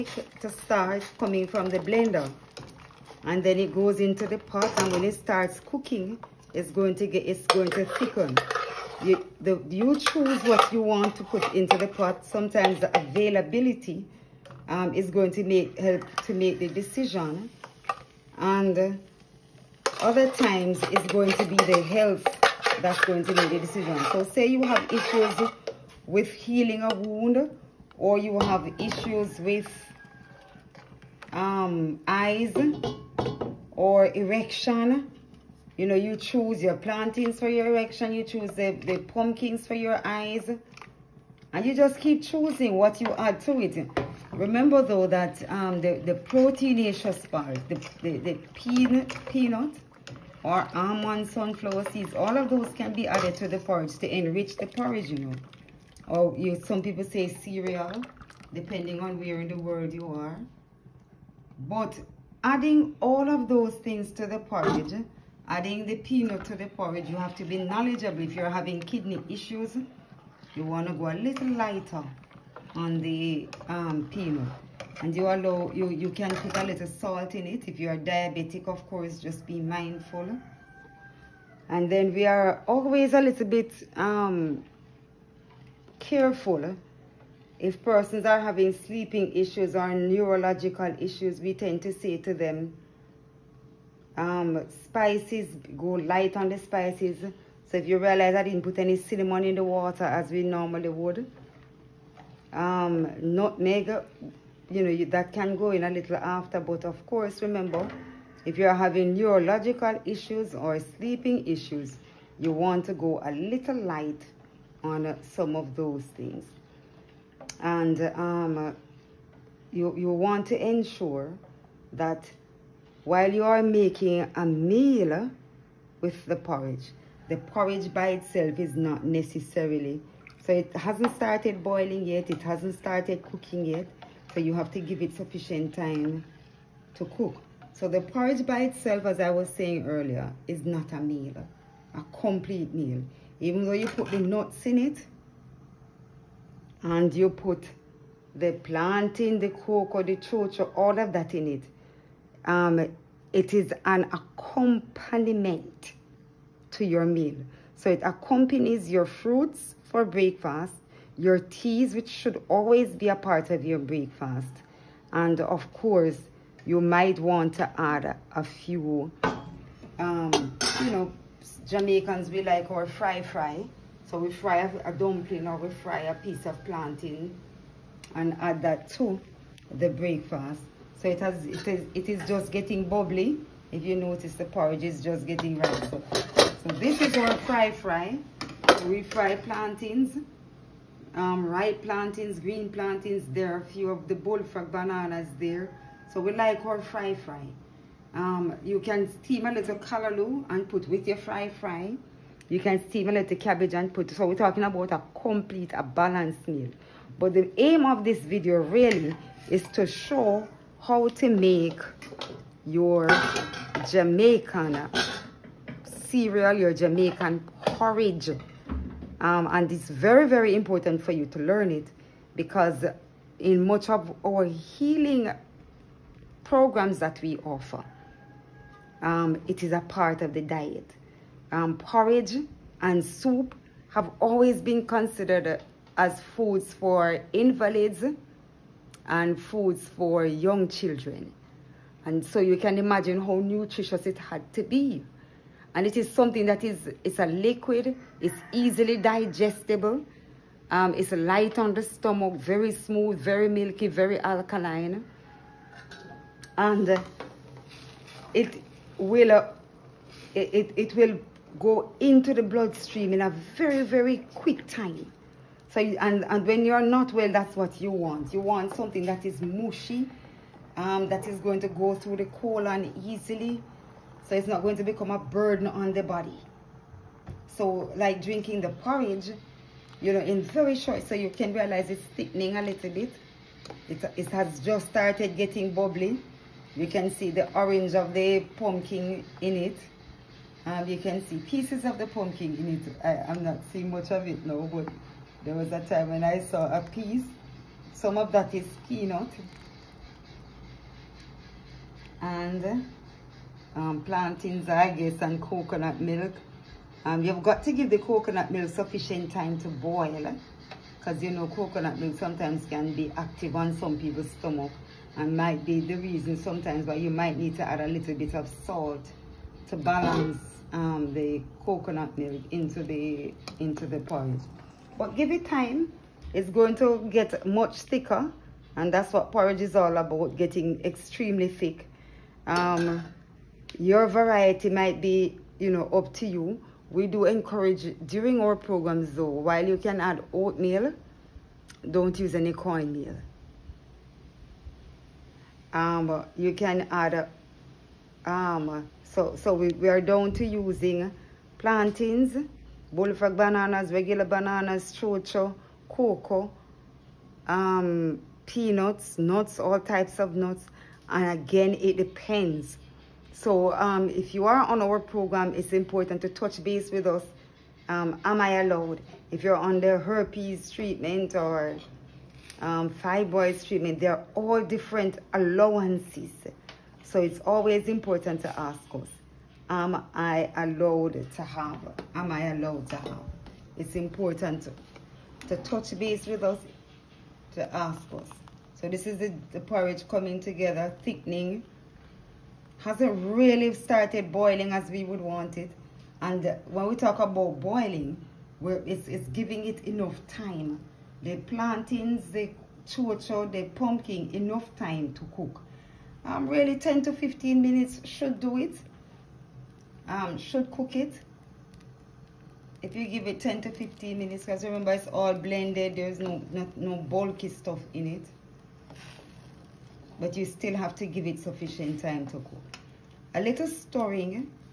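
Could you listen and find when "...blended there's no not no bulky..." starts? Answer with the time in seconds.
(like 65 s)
415 s.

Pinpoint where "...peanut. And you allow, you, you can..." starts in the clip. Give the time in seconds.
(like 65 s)
74 s.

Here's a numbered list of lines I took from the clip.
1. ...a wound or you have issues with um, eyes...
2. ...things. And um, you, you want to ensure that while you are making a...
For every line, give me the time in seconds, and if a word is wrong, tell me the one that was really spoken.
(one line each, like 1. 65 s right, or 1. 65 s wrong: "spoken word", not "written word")
1. 26 s right
2. 116 s right.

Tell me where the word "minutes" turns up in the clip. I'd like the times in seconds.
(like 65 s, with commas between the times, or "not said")
407 s, 414 s.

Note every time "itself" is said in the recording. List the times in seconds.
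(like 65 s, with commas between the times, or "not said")
128 s, 138 s.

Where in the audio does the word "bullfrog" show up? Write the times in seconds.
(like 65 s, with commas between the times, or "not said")
194 s, 352 s.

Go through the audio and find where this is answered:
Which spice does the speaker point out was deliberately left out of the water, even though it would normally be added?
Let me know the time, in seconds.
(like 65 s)
98 s.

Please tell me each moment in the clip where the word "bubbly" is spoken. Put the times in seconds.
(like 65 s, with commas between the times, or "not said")
182 s, 285 s.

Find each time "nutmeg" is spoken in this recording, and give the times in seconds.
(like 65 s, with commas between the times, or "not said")
103 s.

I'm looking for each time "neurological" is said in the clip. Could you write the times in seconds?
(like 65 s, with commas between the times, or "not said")
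89 s, 109 s.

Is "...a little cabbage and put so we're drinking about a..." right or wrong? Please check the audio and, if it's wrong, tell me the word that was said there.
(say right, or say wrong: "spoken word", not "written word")
wrong: "talking", not "drinking".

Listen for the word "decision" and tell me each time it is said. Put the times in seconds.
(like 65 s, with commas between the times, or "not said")
16 s, 23 s.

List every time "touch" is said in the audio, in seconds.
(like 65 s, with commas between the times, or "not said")
366 s, 385 s.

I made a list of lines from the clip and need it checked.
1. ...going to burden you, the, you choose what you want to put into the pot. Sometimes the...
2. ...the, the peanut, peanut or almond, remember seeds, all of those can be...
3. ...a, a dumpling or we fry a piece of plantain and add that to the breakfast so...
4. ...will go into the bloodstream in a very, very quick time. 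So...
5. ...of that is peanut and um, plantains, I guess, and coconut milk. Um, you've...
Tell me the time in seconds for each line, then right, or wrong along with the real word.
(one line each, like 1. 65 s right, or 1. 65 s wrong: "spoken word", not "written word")
1. 7 s wrong: "thicken", not "burden"
2. 48 s wrong: "sunflower", not "remember"
3. 174 s right
4. 260 s right
5. 298 s right.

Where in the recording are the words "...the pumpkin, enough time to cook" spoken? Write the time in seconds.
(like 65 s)
403 s.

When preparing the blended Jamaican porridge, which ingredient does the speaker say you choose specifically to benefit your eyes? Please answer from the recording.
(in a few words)
pumpkins.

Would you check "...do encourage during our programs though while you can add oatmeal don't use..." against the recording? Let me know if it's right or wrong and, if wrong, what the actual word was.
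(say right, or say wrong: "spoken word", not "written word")
right.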